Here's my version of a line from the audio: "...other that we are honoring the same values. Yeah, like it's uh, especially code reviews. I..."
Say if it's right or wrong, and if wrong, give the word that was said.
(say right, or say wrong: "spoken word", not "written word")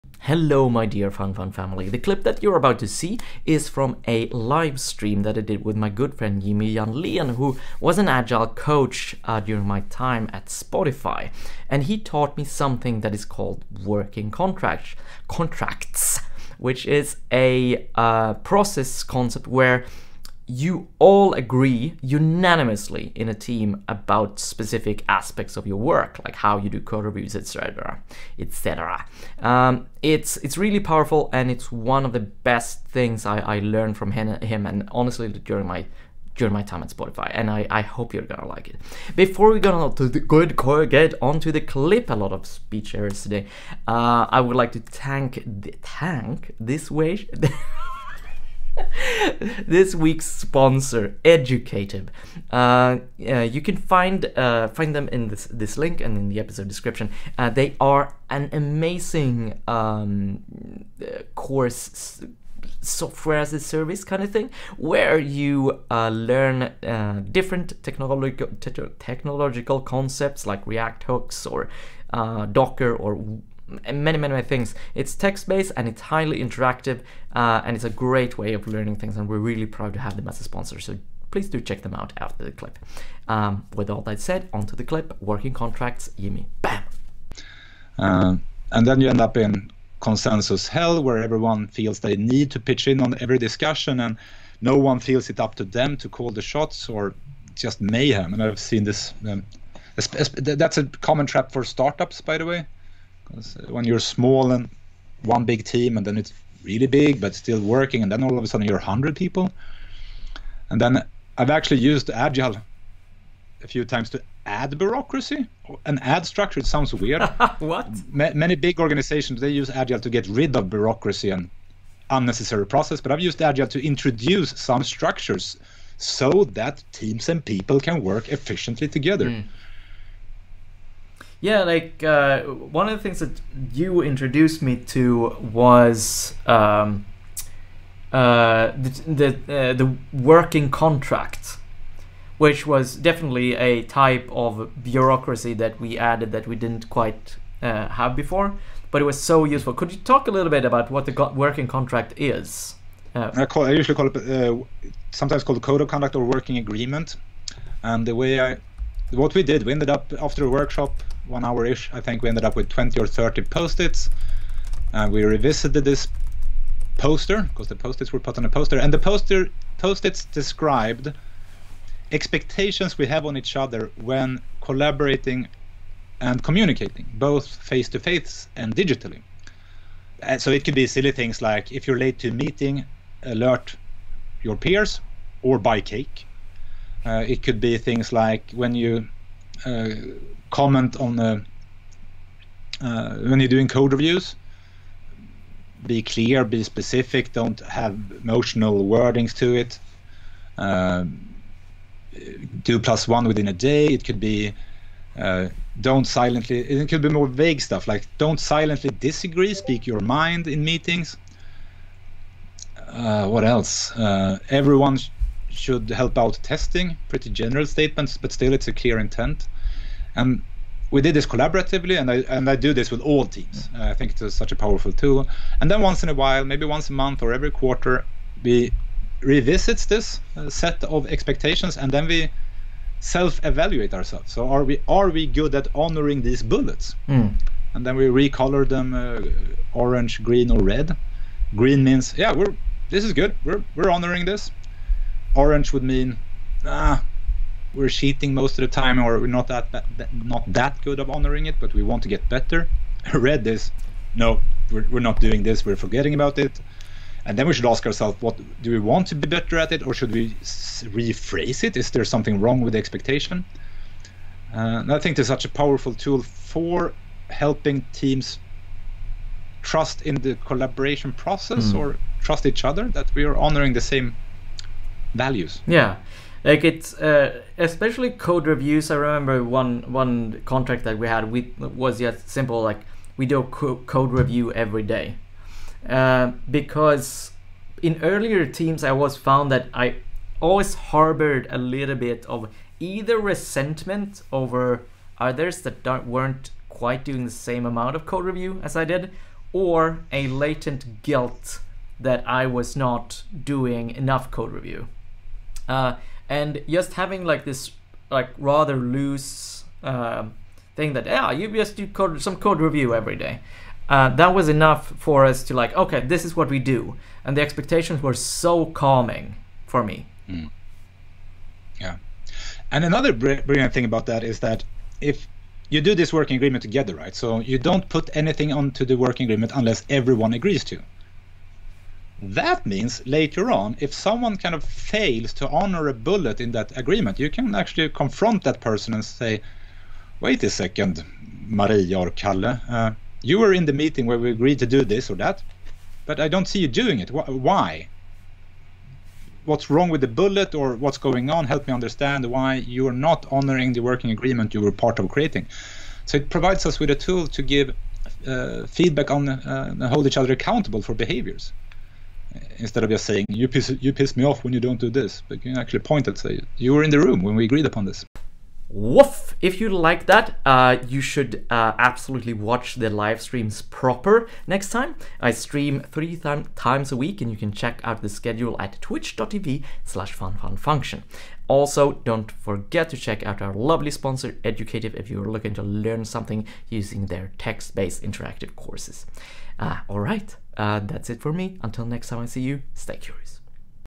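right.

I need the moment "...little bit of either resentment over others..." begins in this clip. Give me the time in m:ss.
4:51.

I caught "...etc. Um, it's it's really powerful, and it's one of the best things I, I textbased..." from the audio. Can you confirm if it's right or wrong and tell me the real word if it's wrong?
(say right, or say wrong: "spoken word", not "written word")
wrong: "learned", not "textbased".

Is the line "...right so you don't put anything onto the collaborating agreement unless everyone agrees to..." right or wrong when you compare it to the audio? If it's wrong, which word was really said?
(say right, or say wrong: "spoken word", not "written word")
wrong: "working", not "collaborating".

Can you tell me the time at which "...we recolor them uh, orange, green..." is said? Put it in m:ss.
3:57.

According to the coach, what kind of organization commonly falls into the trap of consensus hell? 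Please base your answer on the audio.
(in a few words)
startups.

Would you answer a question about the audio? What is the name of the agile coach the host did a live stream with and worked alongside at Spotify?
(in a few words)
Jimmy Janlén.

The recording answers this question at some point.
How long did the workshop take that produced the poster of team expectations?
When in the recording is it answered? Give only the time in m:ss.
2:41.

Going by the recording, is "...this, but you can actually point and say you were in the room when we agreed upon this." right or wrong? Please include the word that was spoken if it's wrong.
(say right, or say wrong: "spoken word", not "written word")
right.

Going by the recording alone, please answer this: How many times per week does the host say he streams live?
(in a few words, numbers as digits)
3.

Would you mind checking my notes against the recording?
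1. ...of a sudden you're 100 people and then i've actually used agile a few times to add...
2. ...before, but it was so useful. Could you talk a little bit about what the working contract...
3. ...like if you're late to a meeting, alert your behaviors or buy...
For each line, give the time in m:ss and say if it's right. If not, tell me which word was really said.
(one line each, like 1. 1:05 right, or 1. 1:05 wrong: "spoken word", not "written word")
1. 1:48 right
2. 2:28 right
3. 3:01 wrong: "peers", not "behaviors".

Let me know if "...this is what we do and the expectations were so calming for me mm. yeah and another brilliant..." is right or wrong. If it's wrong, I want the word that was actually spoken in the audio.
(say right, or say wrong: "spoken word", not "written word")
right.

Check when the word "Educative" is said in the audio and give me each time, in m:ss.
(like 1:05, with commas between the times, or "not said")
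0:51, 6:24.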